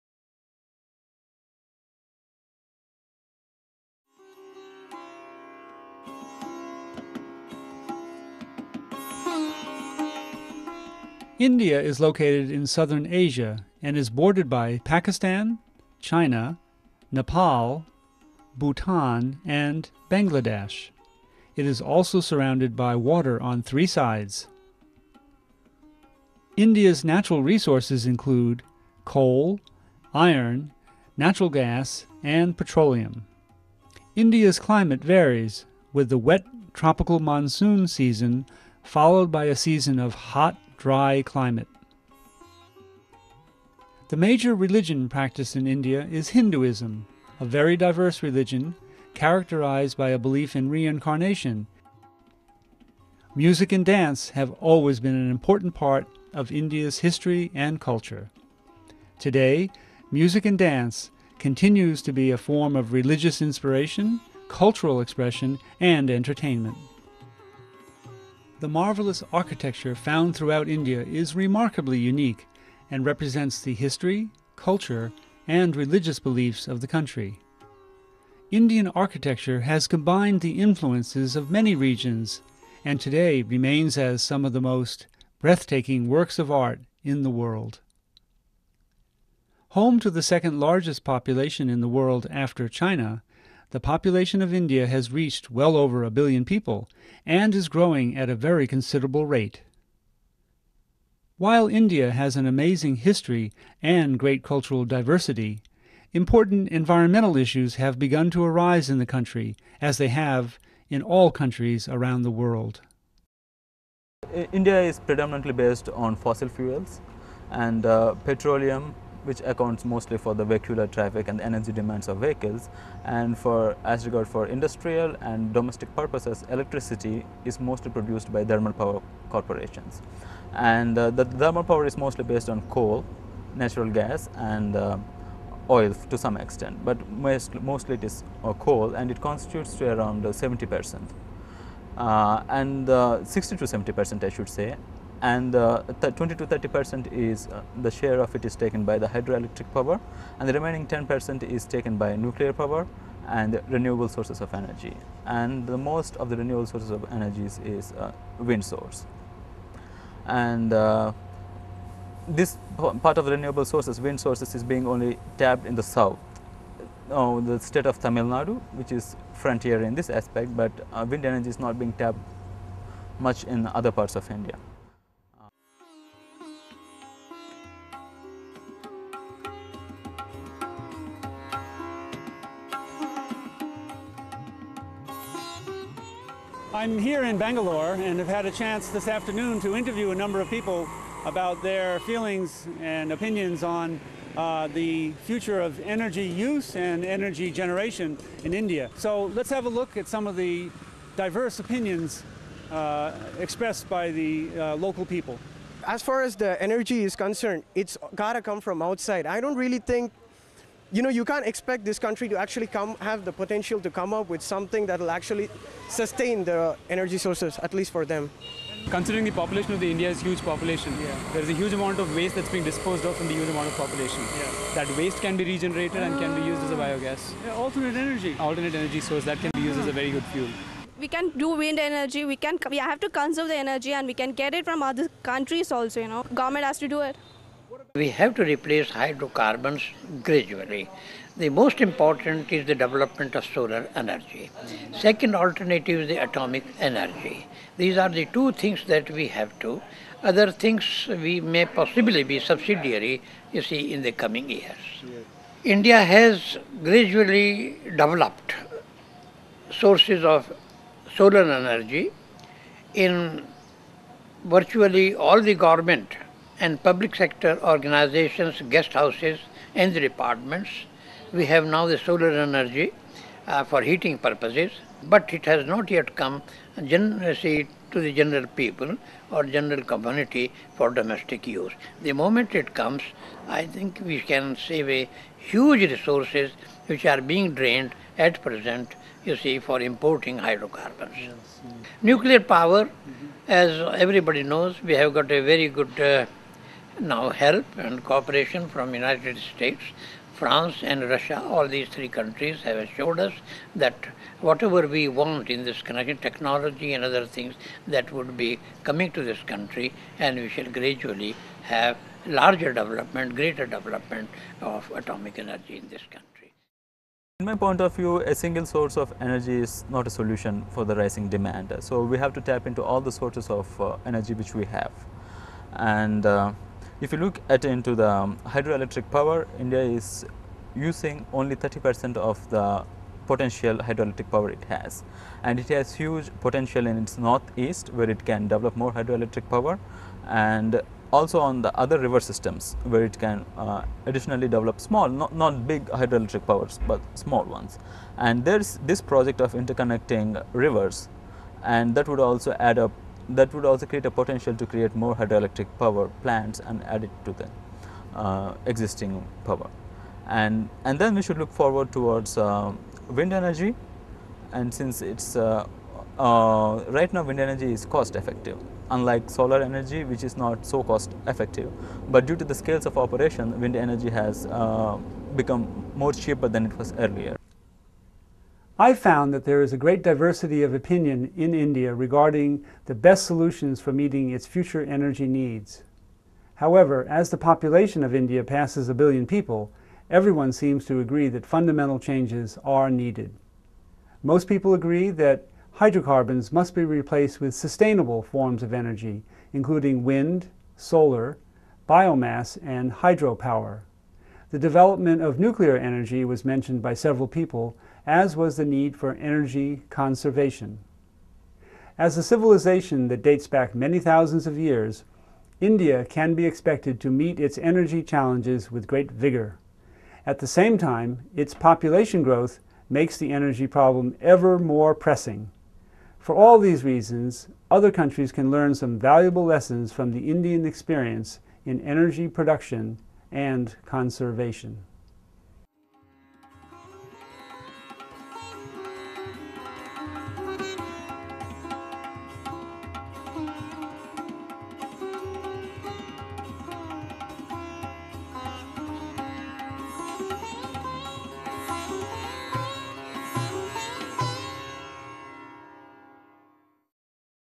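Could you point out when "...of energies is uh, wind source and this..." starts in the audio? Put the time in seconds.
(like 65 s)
156 s.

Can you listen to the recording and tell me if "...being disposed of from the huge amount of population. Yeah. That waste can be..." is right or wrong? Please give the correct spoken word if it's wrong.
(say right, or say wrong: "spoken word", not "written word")
right.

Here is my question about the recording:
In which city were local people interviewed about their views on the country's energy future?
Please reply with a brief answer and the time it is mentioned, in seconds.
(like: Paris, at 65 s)
Bangalore, at 187 s.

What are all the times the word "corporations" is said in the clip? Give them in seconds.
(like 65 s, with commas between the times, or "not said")
129 s.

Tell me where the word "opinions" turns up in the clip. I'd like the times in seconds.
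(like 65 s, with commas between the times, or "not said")
193 s, 201 s, 380 s.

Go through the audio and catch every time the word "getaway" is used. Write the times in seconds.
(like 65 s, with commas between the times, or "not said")
not said.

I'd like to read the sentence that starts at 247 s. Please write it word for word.
These are the two things that we have to.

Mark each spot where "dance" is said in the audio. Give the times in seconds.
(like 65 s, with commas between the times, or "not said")
53 s, 60 s.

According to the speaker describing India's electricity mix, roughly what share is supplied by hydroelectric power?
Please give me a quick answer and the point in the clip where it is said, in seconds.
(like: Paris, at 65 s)
20 to 30 percent, at 146 s.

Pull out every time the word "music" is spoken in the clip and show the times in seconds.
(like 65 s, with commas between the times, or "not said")
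53 s, 60 s.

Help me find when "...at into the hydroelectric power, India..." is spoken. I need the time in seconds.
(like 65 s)
327 s.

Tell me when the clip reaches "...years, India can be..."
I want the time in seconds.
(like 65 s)
414 s.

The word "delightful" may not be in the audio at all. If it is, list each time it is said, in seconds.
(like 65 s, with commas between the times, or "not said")
not said.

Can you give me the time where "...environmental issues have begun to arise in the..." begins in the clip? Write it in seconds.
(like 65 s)
106 s.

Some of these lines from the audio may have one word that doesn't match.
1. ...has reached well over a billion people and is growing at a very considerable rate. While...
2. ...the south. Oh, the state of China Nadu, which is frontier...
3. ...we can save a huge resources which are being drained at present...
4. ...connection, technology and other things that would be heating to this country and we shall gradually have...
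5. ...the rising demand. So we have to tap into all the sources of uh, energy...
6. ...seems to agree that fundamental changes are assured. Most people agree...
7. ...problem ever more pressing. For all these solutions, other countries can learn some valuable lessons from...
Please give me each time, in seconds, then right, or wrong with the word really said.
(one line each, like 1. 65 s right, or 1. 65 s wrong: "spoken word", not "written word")
1. 94 s right
2. 165 s wrong: "Tamil", not "China"
3. 284 s right
4. 305 s wrong: "coming", not "heating"
5. 320 s right
6. 390 s wrong: "needed", not "assured"
7. 423 s wrong: "reasons", not "solutions".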